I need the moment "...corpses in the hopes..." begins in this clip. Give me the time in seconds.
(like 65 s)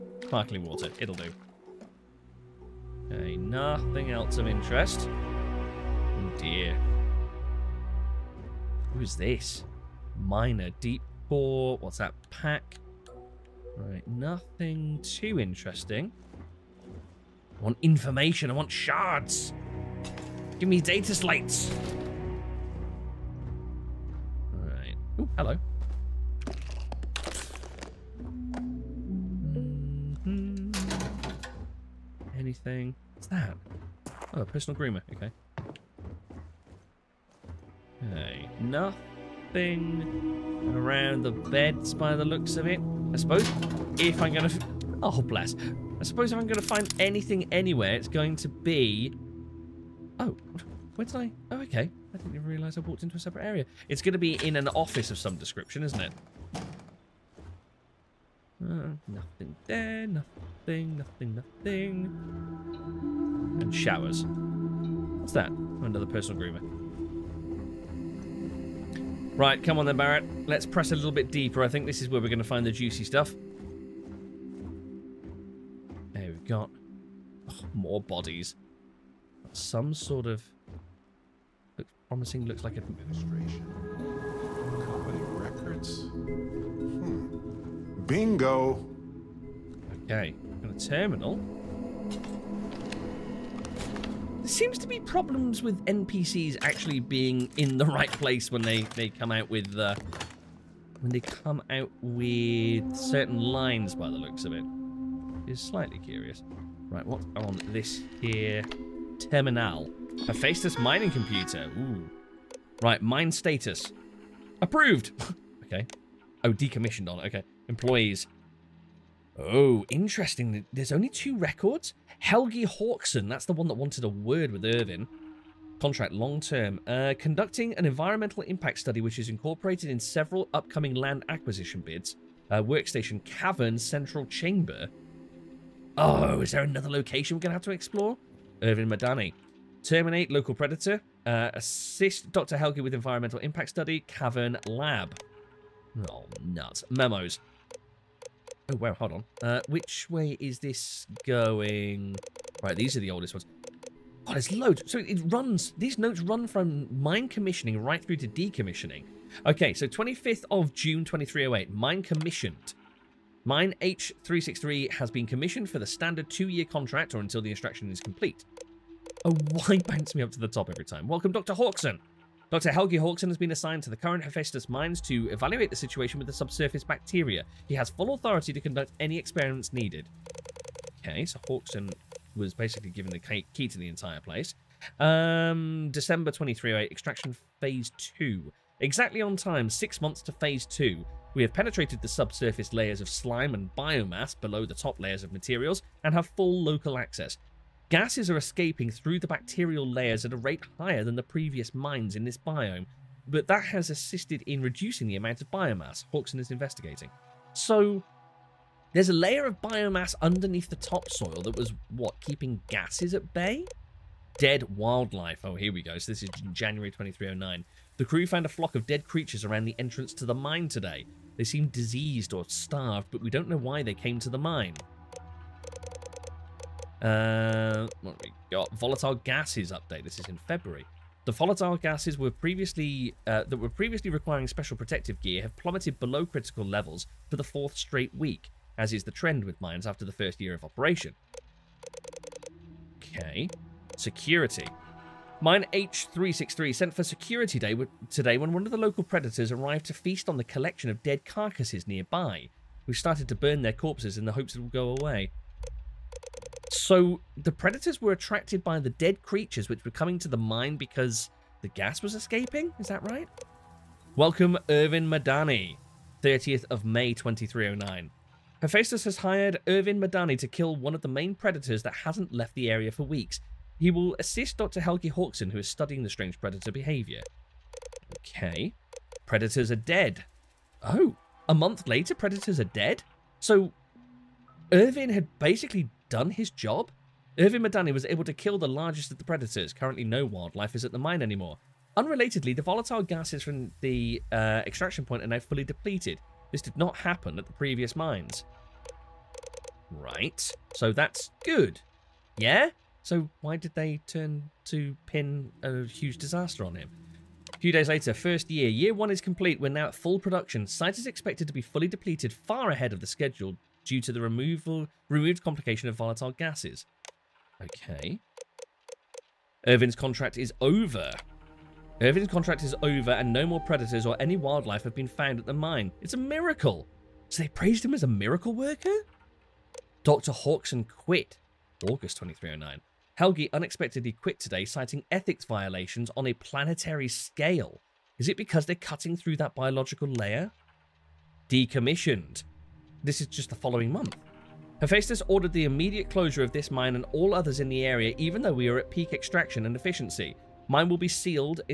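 253 s.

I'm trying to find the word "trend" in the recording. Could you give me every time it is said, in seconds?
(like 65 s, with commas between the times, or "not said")
239 s.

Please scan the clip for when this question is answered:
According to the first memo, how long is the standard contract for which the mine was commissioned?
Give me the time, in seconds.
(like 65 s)
166 s.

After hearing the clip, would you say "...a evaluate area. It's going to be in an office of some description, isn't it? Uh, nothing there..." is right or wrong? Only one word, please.
wrong.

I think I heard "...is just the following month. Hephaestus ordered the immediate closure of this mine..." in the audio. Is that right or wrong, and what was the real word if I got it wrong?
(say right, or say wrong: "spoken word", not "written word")
right.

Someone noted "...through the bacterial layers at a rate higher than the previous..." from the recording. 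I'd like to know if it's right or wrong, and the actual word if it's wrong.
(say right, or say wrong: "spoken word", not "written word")
right.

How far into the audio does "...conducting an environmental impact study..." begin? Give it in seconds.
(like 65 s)
127 s.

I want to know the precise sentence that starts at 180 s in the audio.
Okay, so Hawkson was basically given the key to the entire place.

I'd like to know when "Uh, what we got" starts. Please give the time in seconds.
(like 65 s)
227 s.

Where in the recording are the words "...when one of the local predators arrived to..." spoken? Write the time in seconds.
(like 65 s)
248 s.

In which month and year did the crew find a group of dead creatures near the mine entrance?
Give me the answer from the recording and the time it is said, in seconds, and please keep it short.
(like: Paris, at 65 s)
January 2309, at 216 s.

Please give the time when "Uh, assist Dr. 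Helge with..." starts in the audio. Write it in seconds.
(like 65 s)
141 s.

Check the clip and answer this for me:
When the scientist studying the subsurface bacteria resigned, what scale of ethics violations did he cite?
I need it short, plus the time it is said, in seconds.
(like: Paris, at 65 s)
planetary scale, at 336 s.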